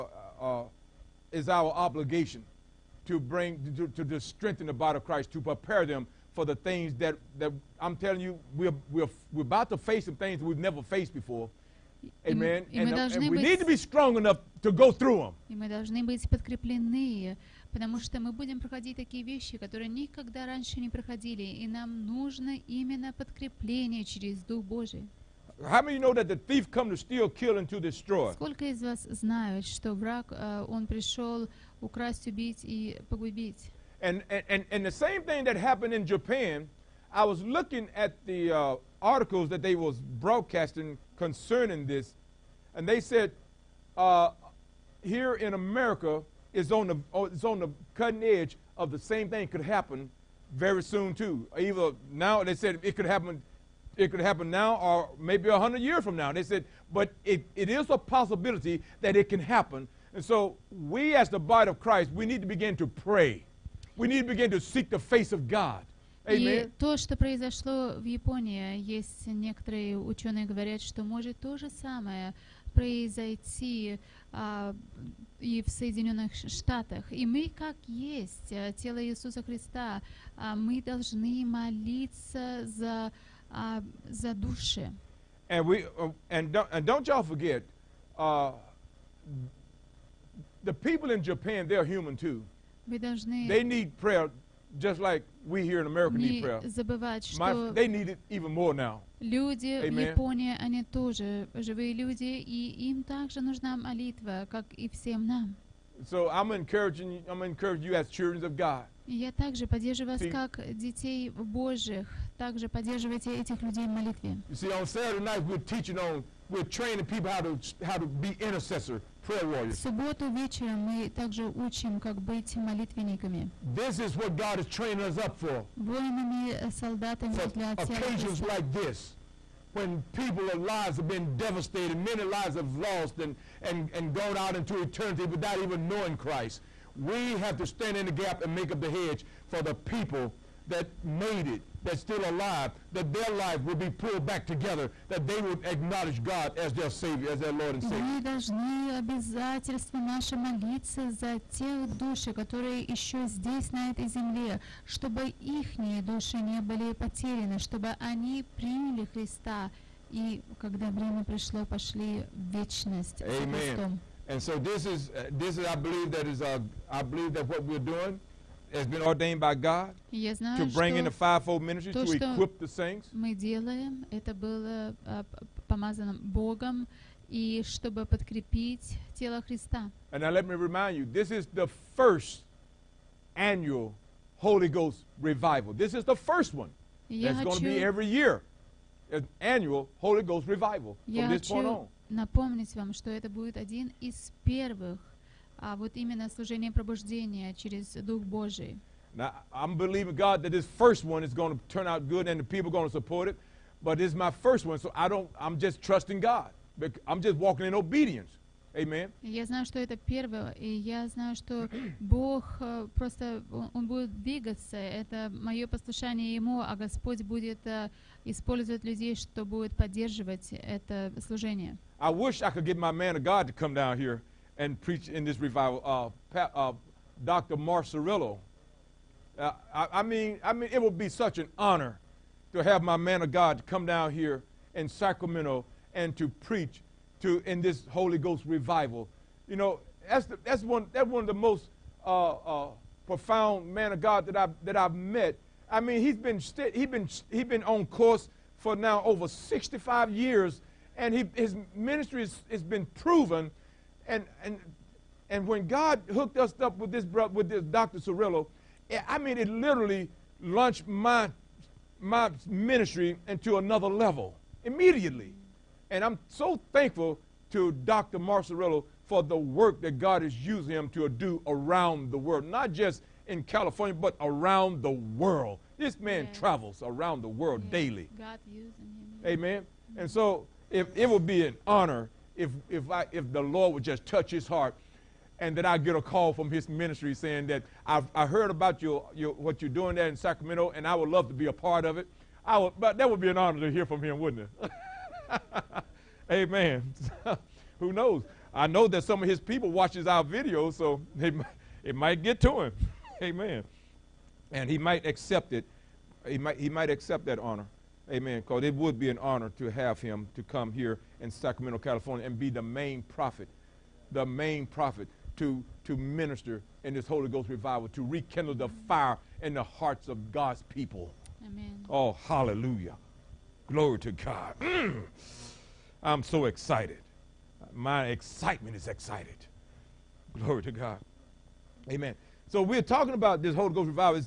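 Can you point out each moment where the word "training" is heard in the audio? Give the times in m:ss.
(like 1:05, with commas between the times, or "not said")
1:56, 2:04.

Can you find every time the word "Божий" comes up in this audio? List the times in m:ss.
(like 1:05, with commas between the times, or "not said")
0:24, 3:18.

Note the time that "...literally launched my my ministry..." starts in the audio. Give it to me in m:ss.
4:19.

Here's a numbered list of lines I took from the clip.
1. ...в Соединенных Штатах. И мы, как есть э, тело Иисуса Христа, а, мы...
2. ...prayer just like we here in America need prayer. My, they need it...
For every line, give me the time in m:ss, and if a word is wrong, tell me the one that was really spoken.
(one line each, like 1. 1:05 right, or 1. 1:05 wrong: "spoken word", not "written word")
1. 1:15 right
2. 1:33 right.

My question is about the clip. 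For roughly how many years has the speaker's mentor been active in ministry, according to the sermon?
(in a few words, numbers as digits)
over 65 years.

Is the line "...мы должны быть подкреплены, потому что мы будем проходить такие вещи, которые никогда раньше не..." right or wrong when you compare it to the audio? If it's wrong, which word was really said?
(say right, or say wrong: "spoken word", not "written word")
right.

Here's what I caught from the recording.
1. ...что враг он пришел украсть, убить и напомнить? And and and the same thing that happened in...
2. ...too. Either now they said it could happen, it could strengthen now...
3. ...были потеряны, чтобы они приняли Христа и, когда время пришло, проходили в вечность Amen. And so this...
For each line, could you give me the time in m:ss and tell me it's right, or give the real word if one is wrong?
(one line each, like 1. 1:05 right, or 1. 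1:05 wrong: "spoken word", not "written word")
1. 0:29 wrong: "погубить", not "напомнить"
2. 0:51 wrong: "happen", not "strengthen"
3. 2:36 wrong: "пошли", not "проходили".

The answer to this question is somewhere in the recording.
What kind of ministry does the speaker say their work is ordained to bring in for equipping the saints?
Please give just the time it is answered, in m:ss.
2:51.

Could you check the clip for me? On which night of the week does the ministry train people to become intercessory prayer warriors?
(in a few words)
Saturday.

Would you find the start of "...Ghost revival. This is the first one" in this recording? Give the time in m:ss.
3:04.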